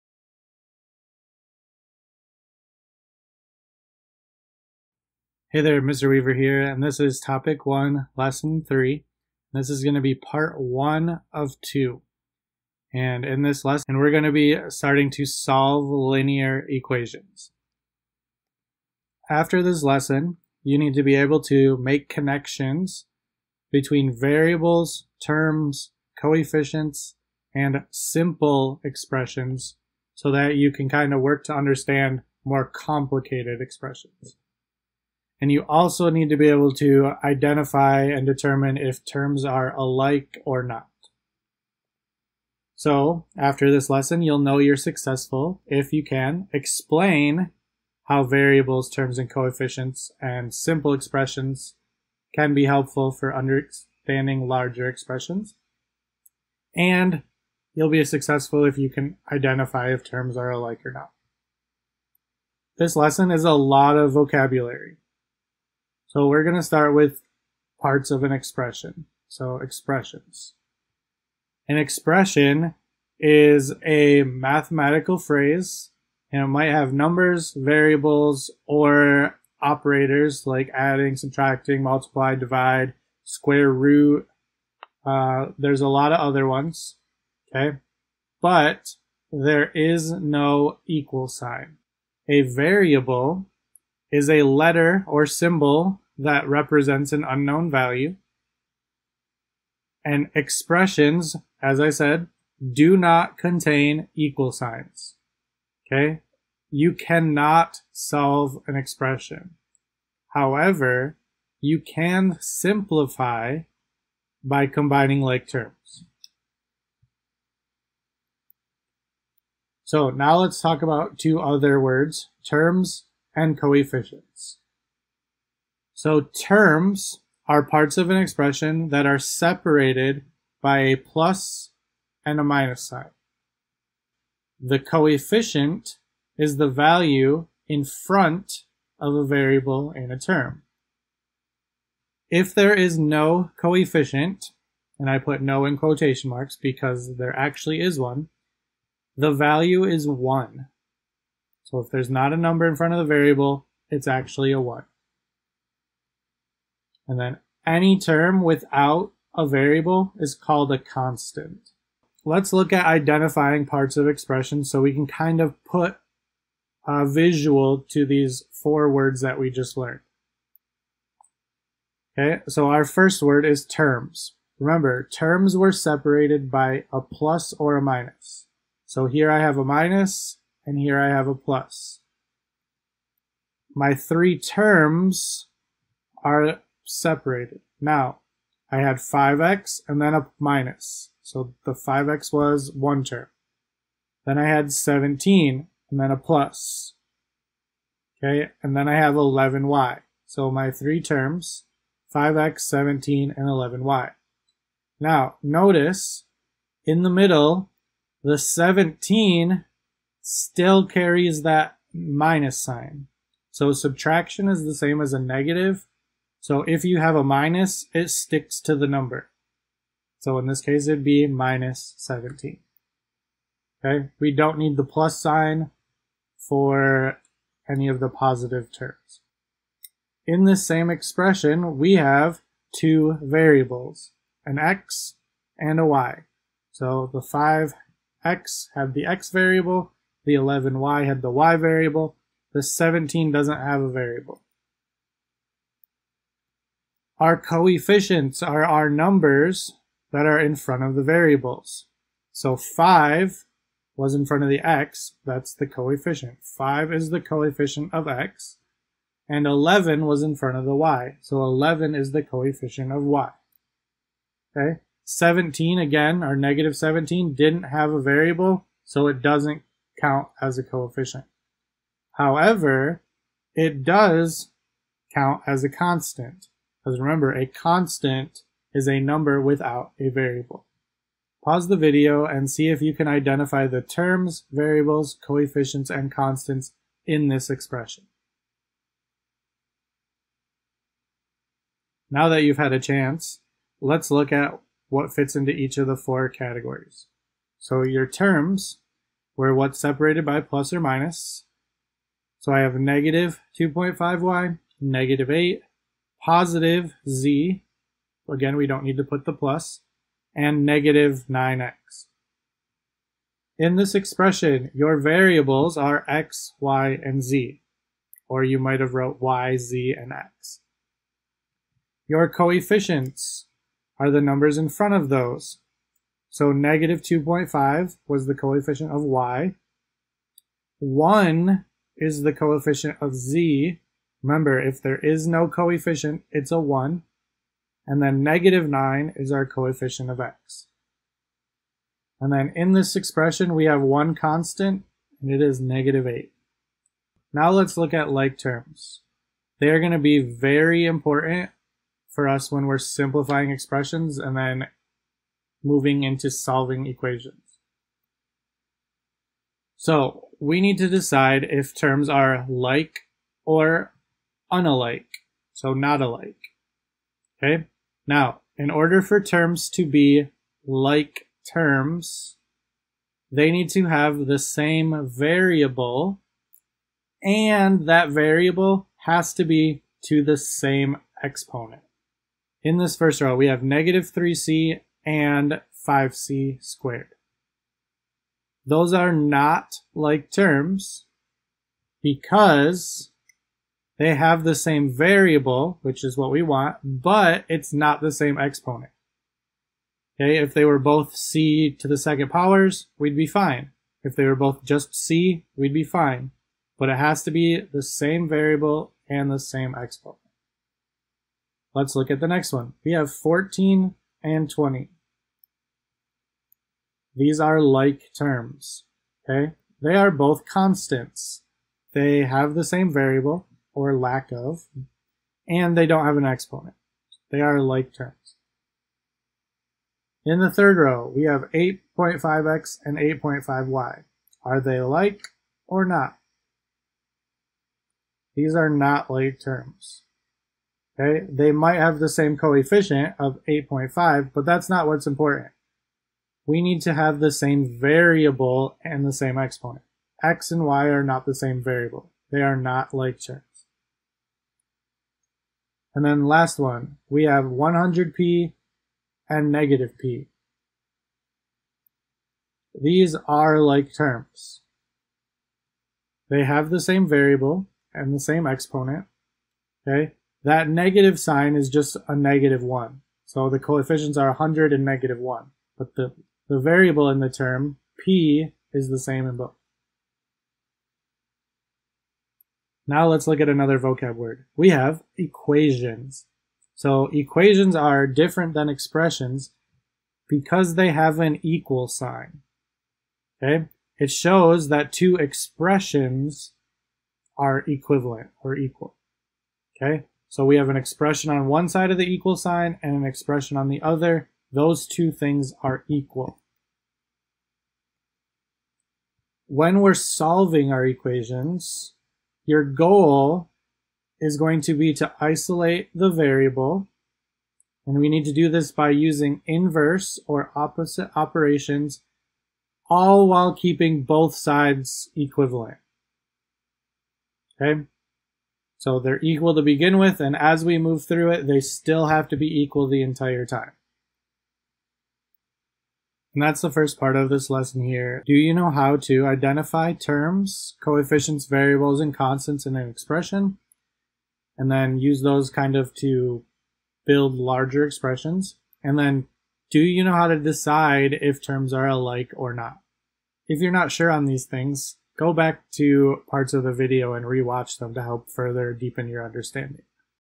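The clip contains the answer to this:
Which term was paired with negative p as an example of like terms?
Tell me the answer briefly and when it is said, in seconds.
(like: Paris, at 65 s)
100p, at 457 s.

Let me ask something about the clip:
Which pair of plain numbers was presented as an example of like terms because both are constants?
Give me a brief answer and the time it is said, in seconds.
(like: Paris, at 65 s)
14 and 20, at 413 s.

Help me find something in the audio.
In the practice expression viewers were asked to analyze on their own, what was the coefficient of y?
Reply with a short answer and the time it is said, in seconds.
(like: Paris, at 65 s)
-2.5, at 326 s.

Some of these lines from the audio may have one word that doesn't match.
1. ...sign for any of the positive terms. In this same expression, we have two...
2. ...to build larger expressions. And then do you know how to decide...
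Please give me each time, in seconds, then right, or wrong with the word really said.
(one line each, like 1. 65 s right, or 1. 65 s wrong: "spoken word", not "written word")
1. 225 s right
2. 545 s right.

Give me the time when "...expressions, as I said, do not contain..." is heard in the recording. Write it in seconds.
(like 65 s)
100 s.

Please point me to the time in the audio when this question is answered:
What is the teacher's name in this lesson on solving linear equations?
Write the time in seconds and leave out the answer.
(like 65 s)
5 s.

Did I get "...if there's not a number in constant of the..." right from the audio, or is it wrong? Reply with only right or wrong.
wrong.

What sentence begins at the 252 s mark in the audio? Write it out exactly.
So 5 was in front of the x, that's the coefficient.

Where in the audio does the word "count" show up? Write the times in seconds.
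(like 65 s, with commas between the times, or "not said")
270 s, 275 s.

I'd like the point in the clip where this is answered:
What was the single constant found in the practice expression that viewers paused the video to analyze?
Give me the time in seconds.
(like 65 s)
345 s.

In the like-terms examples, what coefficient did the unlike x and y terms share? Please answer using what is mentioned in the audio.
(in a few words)
8.5.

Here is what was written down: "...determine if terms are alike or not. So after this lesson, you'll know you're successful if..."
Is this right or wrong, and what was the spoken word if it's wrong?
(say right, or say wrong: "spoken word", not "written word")
right.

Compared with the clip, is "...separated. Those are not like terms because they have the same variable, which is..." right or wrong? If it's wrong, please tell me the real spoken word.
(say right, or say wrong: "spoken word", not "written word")
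wrong: "squared", not "separated".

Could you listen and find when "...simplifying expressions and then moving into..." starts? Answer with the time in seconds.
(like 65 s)
352 s.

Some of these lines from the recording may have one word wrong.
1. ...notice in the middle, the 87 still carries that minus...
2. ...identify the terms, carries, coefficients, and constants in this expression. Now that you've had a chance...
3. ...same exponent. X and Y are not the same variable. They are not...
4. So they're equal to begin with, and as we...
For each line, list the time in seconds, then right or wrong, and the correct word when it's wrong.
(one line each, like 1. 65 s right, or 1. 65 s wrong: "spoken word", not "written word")
1. 205 s wrong: "17", not "87"
2. 283 s wrong: "variables", not "carries"
3. 449 s right
4. 528 s right.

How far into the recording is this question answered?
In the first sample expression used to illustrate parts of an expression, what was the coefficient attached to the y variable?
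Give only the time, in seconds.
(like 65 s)
261 s.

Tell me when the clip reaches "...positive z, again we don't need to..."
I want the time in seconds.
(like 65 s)
306 s.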